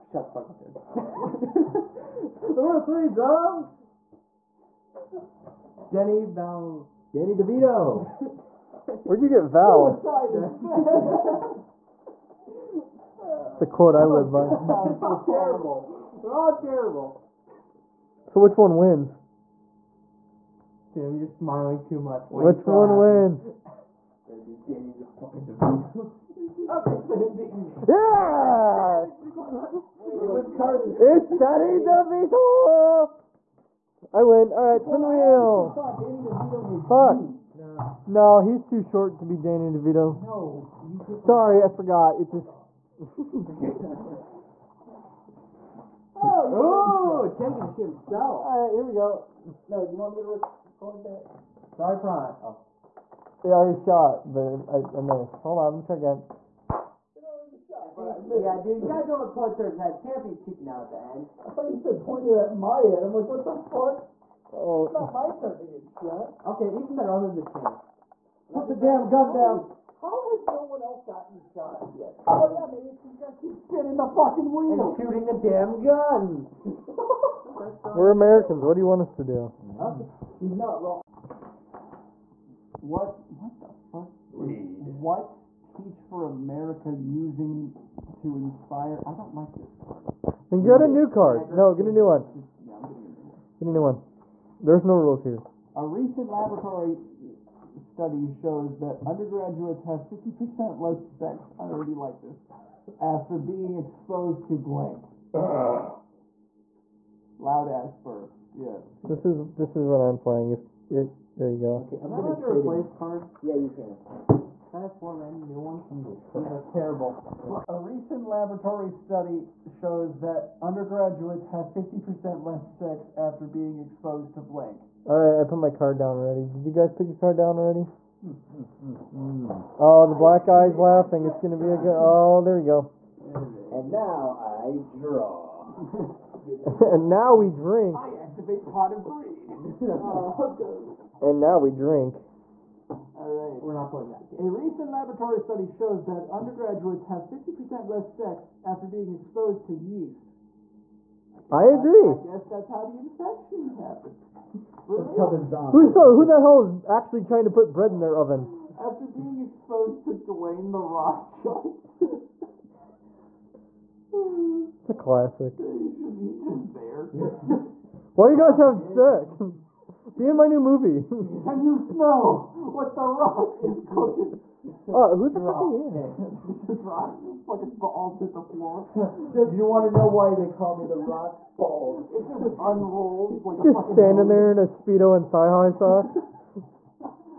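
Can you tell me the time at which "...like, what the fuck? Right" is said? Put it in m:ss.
1:03.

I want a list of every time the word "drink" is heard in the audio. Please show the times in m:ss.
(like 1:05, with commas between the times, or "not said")
2:17, 2:21.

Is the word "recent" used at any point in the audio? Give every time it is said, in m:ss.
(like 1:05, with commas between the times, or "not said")
1:35, 1:57, 2:24.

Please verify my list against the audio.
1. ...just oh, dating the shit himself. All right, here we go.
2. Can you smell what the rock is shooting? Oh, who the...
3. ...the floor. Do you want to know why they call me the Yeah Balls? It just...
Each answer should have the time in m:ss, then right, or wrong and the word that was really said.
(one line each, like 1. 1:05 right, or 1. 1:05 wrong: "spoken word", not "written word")
1. 0:42 wrong: "taking", not "dating"
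2. 2:51 wrong: "cooking", not "shooting"
3. 2:58 wrong: "Rock", not "Yeah".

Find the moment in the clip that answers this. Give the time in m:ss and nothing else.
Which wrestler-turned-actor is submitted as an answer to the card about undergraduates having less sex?
2:40.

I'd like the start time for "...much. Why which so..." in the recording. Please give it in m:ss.
0:21.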